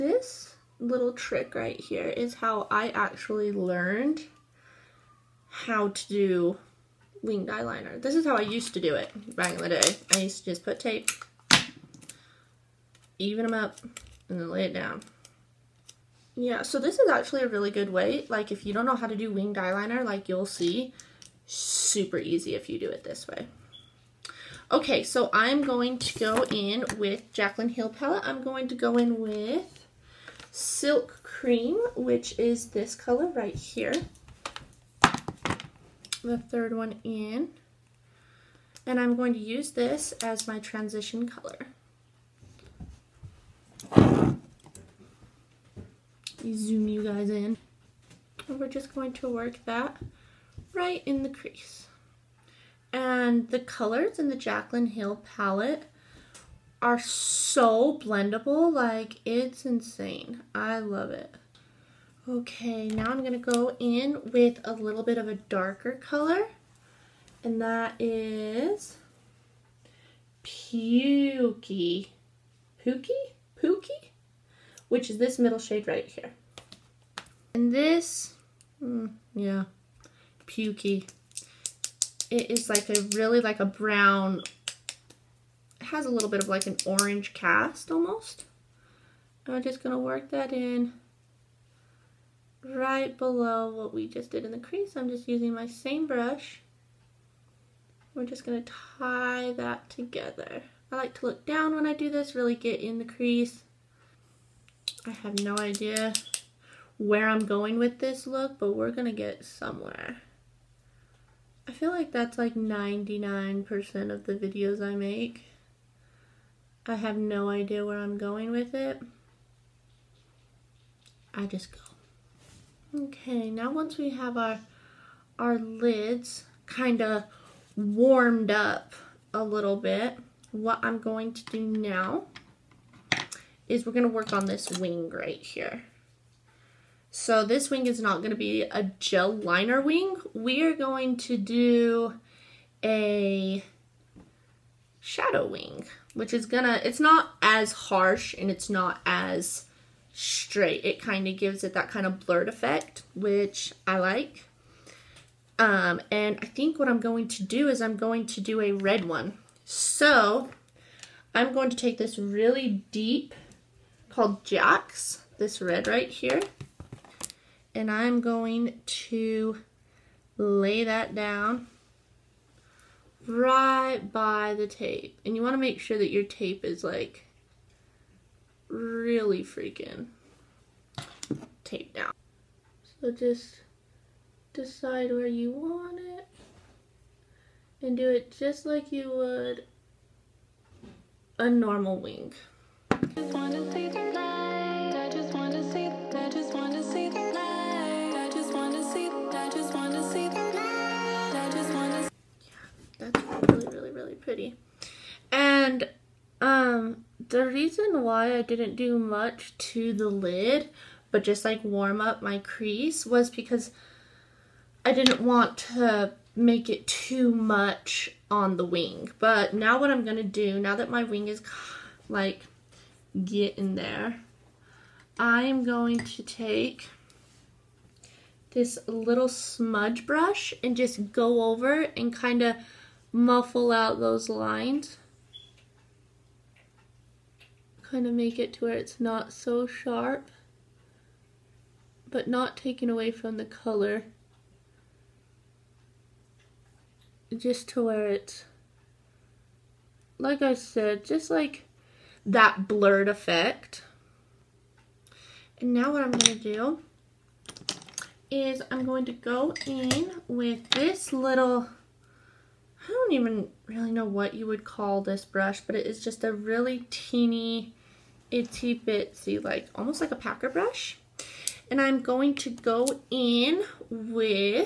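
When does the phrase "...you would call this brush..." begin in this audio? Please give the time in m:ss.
4:24.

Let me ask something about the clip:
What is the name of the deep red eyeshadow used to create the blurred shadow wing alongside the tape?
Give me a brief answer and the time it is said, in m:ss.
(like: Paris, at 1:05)
Jack's, at 2:44.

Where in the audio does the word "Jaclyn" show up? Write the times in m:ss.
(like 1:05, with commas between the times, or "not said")
0:27, 0:54.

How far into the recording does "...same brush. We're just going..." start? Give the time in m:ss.
1:35.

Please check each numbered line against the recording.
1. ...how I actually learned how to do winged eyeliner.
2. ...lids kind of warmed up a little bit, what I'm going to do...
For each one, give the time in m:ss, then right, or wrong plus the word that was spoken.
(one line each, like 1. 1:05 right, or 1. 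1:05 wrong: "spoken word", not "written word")
1. 0:02 right
2. 2:05 right.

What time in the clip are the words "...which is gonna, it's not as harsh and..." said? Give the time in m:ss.
2:26.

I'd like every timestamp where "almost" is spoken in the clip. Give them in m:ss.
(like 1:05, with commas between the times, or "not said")
1:27, 4:29.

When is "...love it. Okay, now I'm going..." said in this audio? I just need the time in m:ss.
1:00.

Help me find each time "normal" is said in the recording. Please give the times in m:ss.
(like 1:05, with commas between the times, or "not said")
3:11.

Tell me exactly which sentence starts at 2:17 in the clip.
So this wing is not going to be a gel liner wing.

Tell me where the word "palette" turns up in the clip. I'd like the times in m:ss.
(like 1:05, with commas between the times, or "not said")
0:27, 0:55.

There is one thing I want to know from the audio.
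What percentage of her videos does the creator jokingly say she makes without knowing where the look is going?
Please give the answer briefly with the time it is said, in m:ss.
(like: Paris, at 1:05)
99%, at 1:52.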